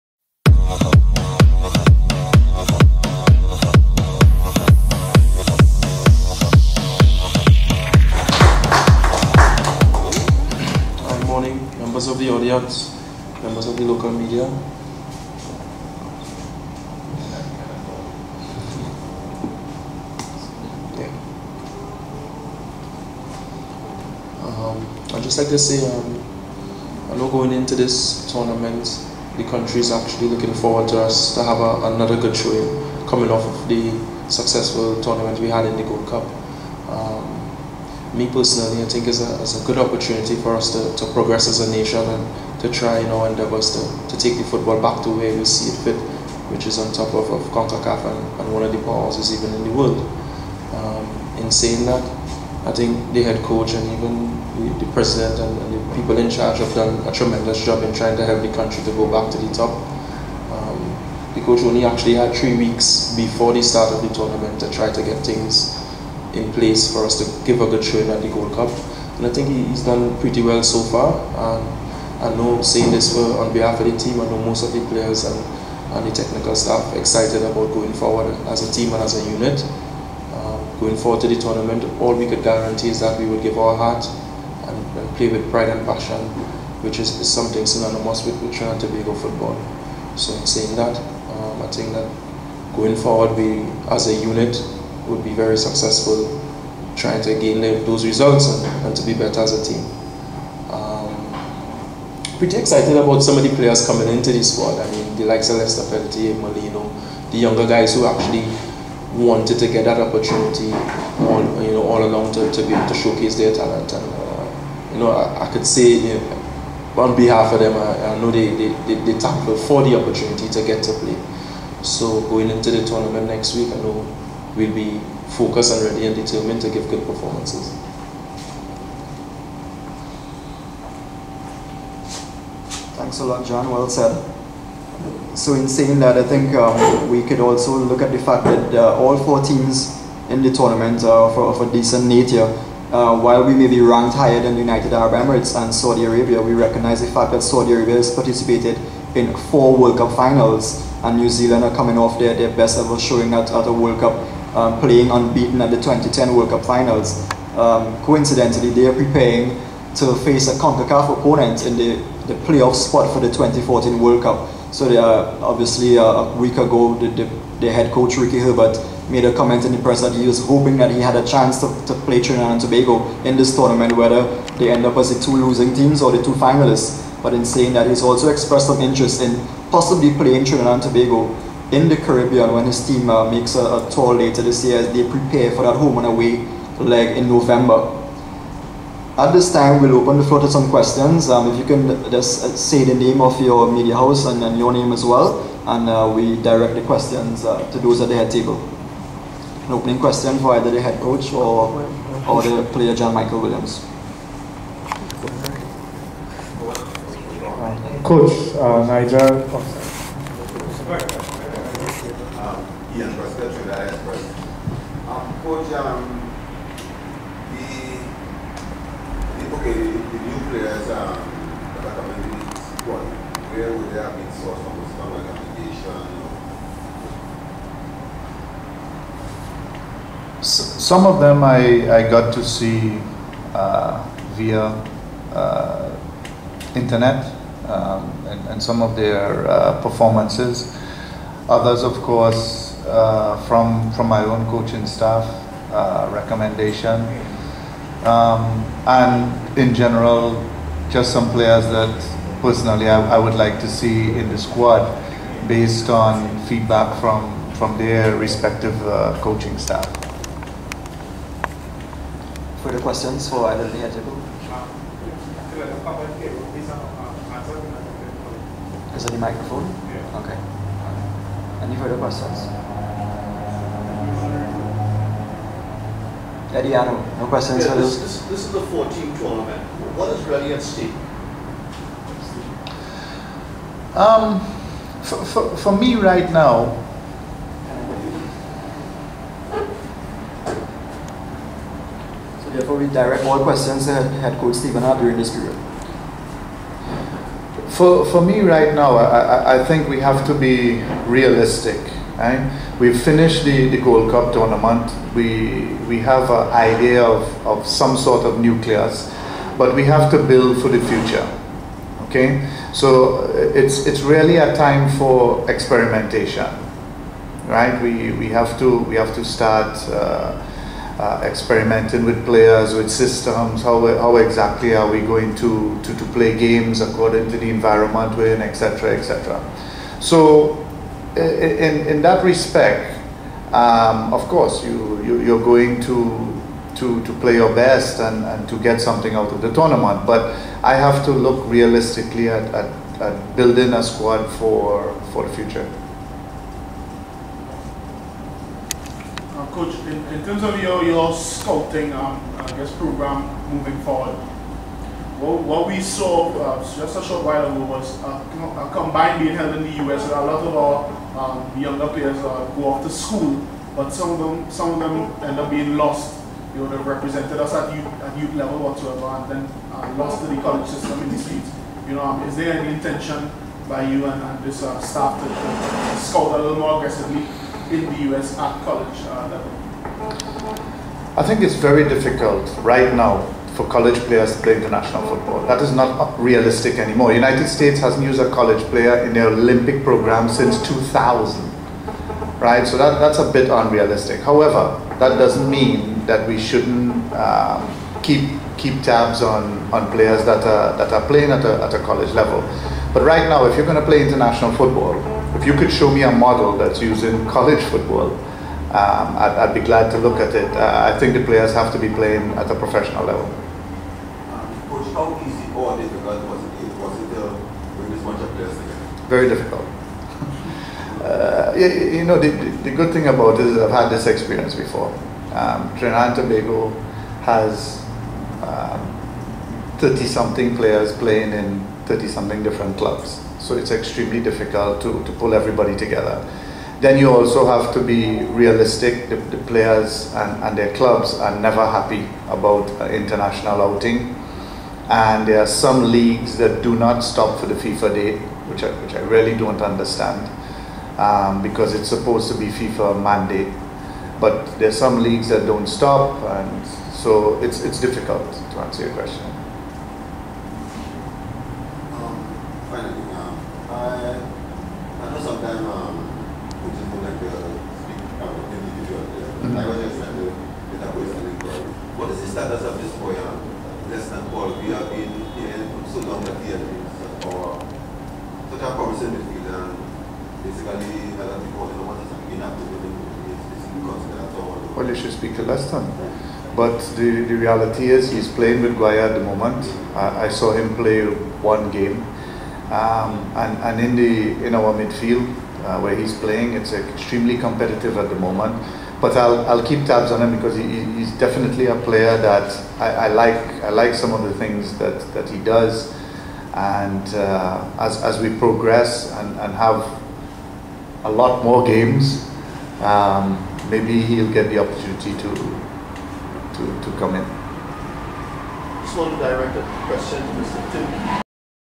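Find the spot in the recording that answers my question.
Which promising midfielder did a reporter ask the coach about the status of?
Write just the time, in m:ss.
7:53.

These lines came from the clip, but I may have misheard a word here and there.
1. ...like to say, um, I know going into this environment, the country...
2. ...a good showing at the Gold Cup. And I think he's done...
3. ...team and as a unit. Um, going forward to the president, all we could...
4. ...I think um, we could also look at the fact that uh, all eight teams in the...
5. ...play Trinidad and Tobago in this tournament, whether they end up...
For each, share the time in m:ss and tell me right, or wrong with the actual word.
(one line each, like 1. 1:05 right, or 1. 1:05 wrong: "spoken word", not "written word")
1. 0:25 wrong: "tournament", not "environment"
2. 1:07 right
3. 1:18 wrong: "tournament", not "president"
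4. 2:16 wrong: "four", not "eight"
5. 2:52 right.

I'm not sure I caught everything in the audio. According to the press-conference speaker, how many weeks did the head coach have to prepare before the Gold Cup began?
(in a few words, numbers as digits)
3.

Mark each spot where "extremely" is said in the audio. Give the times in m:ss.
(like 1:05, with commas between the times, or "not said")
7:13, 8:16.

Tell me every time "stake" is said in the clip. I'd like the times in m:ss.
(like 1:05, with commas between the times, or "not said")
4:40.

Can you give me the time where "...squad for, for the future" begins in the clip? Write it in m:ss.
5:43.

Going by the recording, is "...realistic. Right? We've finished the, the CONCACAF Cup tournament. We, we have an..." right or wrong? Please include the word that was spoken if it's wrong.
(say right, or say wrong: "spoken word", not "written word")
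wrong: "Gold", not "CONCACAF".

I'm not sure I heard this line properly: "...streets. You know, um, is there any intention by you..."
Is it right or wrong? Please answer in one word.
right.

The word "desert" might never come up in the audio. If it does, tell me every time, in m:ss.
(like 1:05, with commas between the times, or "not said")
not said.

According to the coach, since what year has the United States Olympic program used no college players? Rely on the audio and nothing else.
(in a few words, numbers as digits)
2000.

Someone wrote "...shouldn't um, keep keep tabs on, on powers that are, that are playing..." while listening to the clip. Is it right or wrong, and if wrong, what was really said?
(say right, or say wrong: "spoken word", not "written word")
wrong: "players", not "powers".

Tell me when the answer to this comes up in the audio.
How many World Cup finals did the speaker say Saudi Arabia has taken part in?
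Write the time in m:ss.
2:29.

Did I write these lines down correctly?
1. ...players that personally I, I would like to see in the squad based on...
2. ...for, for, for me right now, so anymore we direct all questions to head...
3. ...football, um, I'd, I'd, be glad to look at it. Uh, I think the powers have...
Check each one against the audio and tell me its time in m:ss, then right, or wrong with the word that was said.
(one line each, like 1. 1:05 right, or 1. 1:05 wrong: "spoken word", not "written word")
1. 4:11 right
2. 4:45 wrong: "therefore", not "anymore"
3. 6:47 wrong: "players", not "powers".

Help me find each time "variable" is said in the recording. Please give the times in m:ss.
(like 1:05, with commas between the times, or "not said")
not said.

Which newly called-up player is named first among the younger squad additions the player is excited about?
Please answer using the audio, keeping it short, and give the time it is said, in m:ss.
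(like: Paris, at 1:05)
Lester Peltier, at 1:45.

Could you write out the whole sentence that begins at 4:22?
Further questions for either of the Ajabo?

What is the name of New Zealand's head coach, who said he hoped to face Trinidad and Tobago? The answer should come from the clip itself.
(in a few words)
Ricky Herbert.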